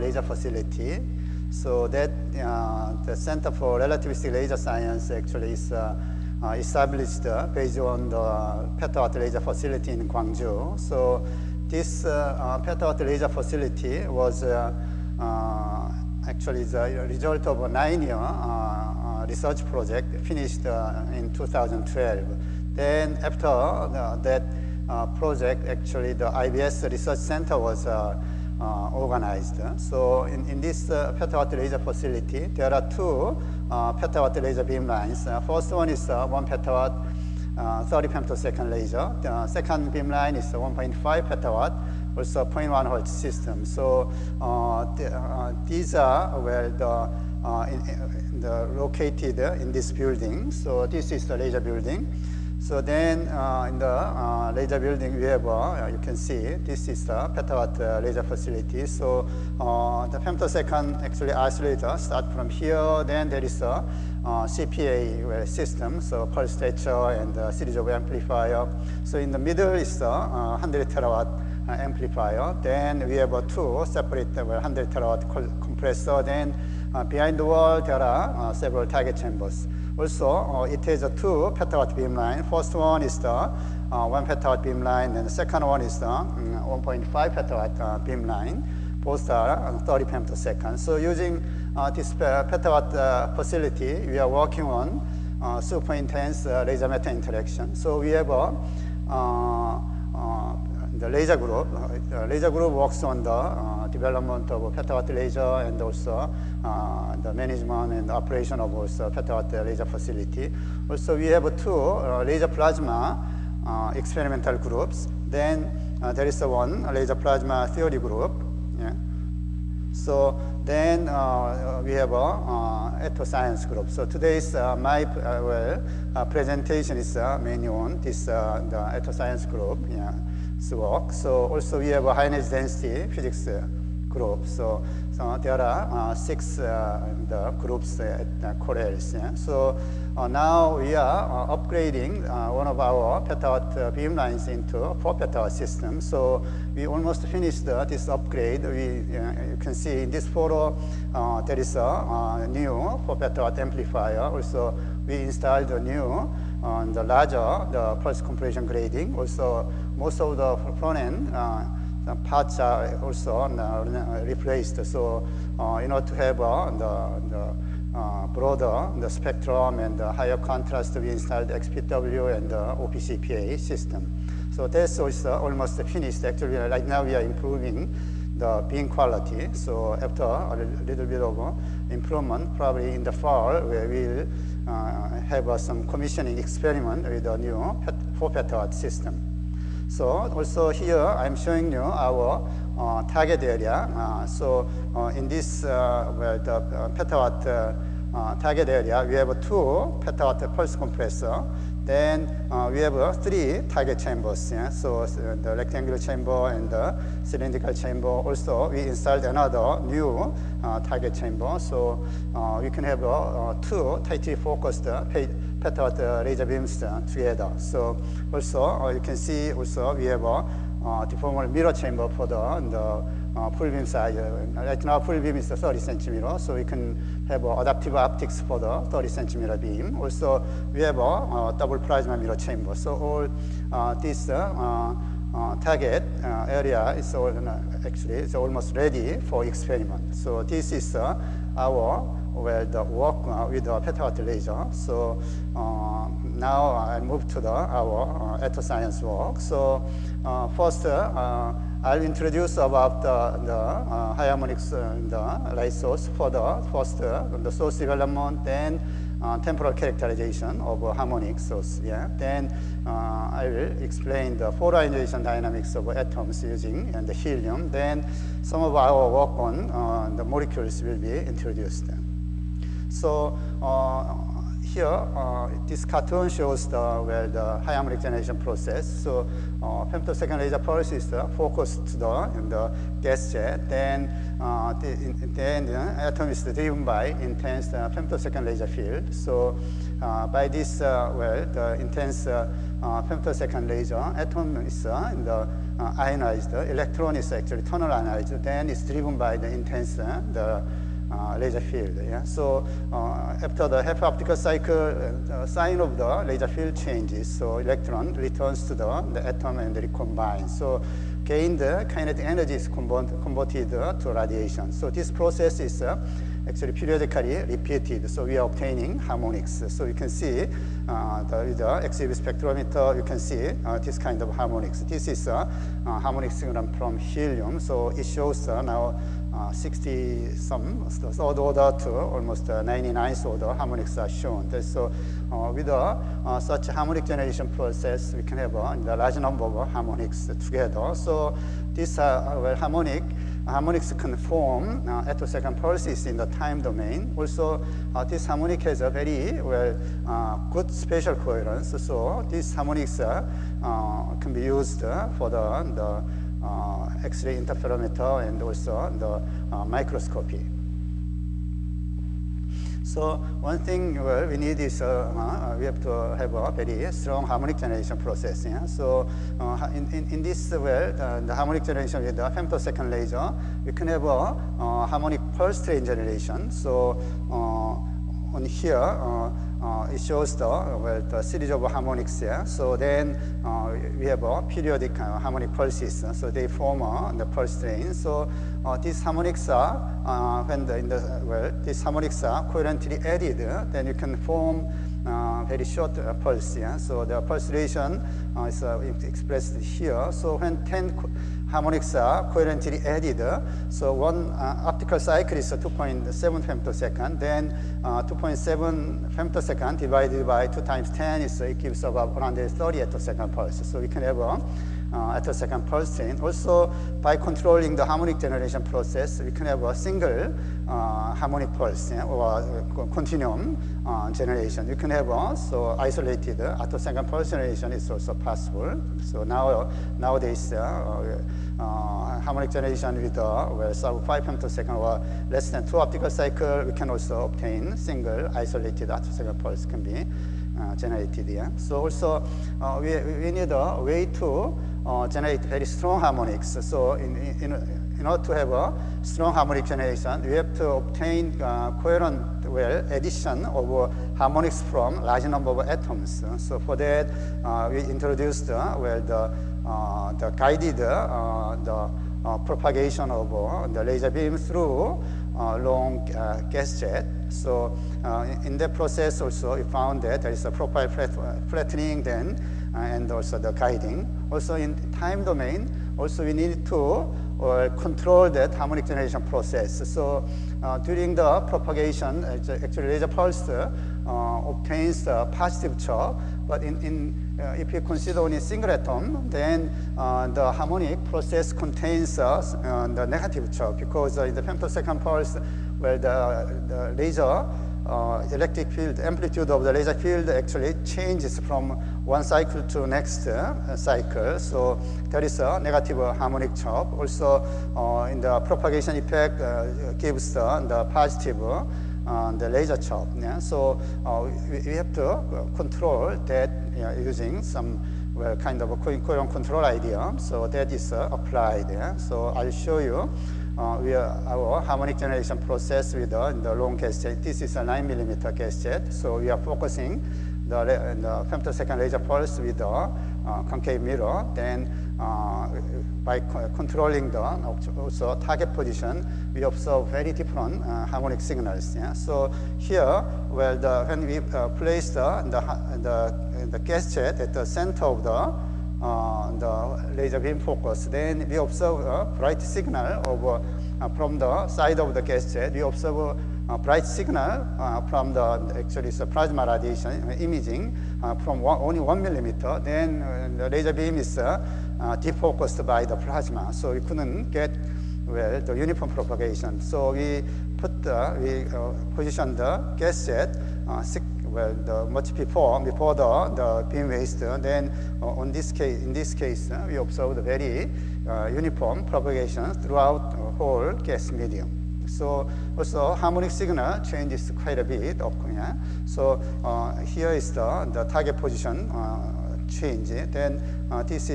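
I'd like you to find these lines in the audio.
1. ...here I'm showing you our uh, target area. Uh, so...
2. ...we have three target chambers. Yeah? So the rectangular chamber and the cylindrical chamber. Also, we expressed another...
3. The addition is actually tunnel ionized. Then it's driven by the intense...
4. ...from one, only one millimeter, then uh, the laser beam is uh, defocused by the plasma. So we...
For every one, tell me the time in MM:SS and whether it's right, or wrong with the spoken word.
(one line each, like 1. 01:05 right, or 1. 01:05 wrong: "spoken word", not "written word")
1. 03:10 right
2. 03:22 wrong: "installed", not "expressed"
3. 04:56 wrong: "electron", not "addition"
4. 09:21 right.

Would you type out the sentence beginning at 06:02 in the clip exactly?
So one thing well, we need is uh, uh, we have to have a very strong harmonic generation process.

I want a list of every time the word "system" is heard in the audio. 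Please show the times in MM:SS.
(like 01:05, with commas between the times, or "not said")
00:43, 01:05, 02:25, 02:53, 03:08.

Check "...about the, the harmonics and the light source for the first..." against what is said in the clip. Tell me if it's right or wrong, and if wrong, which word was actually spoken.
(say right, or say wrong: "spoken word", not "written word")
right.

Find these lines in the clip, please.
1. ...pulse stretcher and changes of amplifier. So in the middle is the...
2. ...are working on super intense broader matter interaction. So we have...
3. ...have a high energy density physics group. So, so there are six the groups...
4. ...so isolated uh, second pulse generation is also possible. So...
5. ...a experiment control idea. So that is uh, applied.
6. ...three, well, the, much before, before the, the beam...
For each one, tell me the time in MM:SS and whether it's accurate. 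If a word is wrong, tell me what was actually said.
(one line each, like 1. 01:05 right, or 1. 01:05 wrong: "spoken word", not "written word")
1. 01:06 wrong: "series", not "changes"
2. 01:34 wrong: "laser", not "broader"
3. 02:11 right
4. 07:05 right
5. 08:38 wrong: "coherent", not "experiment"
6. 09:33 wrong: "six", not "three".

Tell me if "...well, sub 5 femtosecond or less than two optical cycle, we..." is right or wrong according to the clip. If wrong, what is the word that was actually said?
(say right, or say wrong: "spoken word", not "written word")
right.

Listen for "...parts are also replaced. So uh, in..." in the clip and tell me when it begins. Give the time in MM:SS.
02:42.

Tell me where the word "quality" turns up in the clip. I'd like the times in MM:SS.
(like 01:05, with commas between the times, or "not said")
02:58.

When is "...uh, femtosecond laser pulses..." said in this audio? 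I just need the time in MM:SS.
04:39.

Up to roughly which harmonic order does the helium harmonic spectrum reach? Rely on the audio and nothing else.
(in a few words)
99th order.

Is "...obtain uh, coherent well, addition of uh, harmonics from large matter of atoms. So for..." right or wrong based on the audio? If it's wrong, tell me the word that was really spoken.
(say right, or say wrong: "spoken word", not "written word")
wrong: "number", not "matter".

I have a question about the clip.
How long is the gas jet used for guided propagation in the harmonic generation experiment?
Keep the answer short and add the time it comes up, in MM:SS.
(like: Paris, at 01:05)
9 millimeter, at 08:47.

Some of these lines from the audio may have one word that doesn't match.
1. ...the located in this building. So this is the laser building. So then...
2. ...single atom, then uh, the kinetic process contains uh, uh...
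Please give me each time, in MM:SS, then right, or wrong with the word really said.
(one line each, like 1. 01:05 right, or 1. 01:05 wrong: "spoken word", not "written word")
1. 00:48 right
2. 08:08 wrong: "harmonic", not "kinetic".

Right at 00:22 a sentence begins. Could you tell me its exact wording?
Then after uh, that uh, project, actually the IBS Research Center was uh, uh, organized.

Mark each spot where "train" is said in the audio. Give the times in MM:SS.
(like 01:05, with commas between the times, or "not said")
06:15, 06:27.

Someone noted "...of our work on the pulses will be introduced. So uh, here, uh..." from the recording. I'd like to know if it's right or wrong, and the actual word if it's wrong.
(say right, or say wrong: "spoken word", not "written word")
wrong: "molecules", not "pulses".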